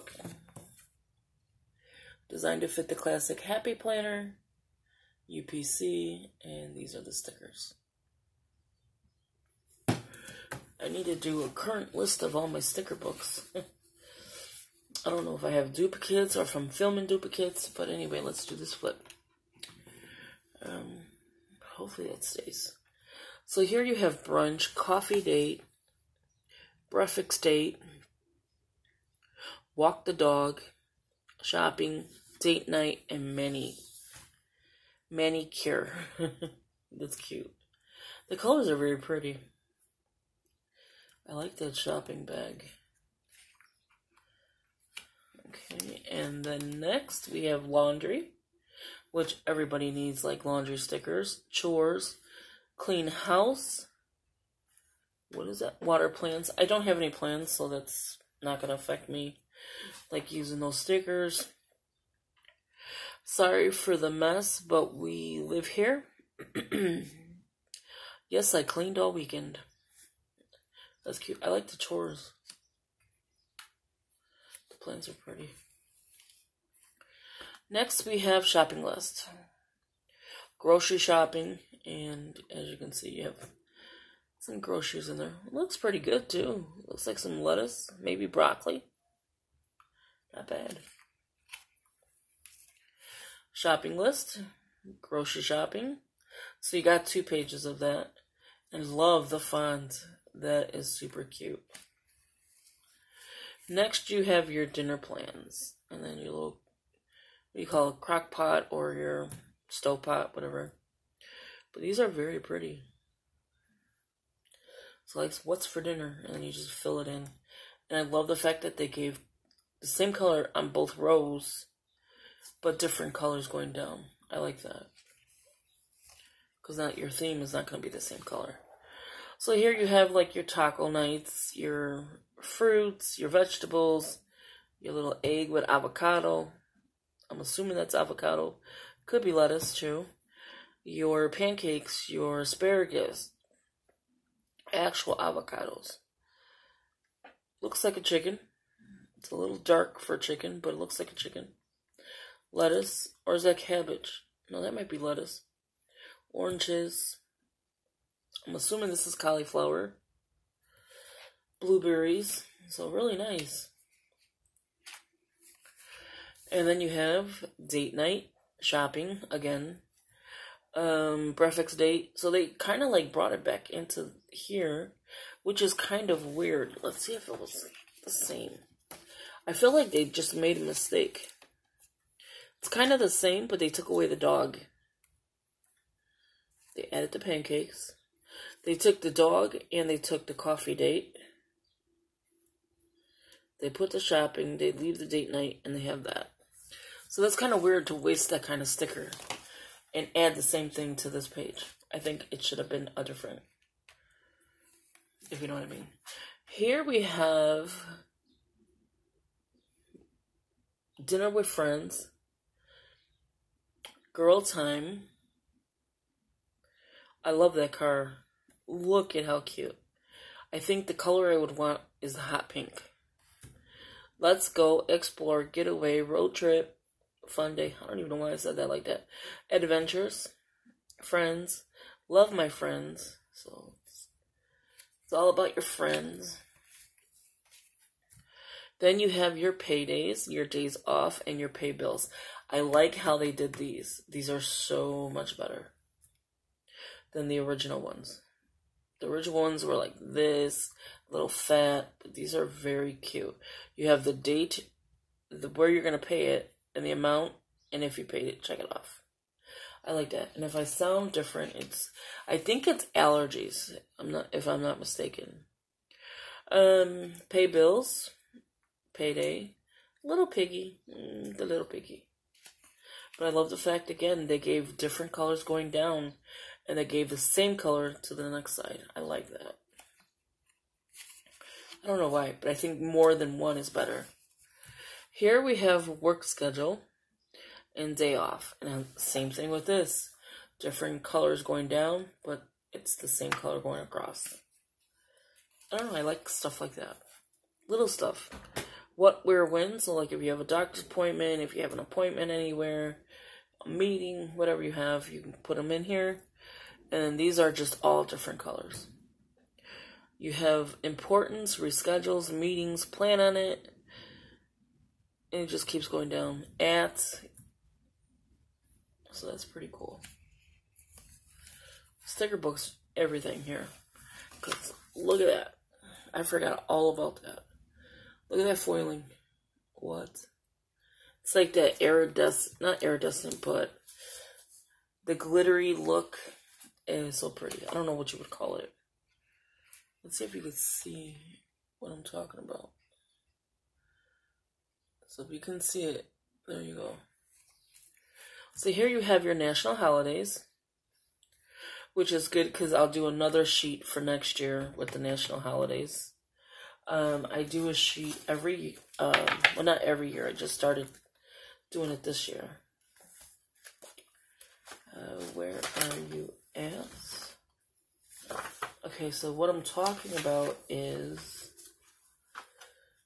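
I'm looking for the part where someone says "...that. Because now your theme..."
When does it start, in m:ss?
2:04.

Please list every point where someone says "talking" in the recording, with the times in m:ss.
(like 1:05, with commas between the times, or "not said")
5:42, 6:09.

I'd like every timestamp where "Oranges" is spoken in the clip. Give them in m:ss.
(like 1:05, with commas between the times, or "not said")
2:36.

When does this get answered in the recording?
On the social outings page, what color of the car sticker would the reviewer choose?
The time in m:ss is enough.
3:42.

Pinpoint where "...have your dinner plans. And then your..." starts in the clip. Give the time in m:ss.
1:44.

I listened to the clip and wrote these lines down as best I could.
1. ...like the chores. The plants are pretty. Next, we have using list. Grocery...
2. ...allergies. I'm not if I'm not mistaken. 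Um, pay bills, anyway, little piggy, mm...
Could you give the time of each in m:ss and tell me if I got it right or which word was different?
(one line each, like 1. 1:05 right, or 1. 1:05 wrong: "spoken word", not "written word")
1. 1:11 wrong: "shopping", not "using"
2. 4:22 wrong: "payday", not "anyway".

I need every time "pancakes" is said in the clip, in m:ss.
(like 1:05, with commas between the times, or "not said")
2:21, 3:07.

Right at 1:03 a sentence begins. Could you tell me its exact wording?
Sorry for the mess, but we live here.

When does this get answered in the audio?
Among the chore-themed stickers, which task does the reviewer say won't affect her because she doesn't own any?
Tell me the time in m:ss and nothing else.
0:55.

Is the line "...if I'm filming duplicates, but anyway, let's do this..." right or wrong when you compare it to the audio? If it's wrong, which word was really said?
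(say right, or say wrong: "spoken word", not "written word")
right.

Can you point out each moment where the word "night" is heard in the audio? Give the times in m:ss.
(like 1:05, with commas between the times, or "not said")
0:32, 2:10, 2:47, 3:15.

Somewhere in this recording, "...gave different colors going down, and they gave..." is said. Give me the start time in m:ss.
4:34.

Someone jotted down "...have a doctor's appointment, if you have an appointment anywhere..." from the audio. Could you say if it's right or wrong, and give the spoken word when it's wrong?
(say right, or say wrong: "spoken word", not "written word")
right.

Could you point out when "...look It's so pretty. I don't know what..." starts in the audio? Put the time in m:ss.
5:35.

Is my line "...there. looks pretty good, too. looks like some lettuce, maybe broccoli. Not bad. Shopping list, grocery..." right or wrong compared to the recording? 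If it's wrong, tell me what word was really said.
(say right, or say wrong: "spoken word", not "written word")
right.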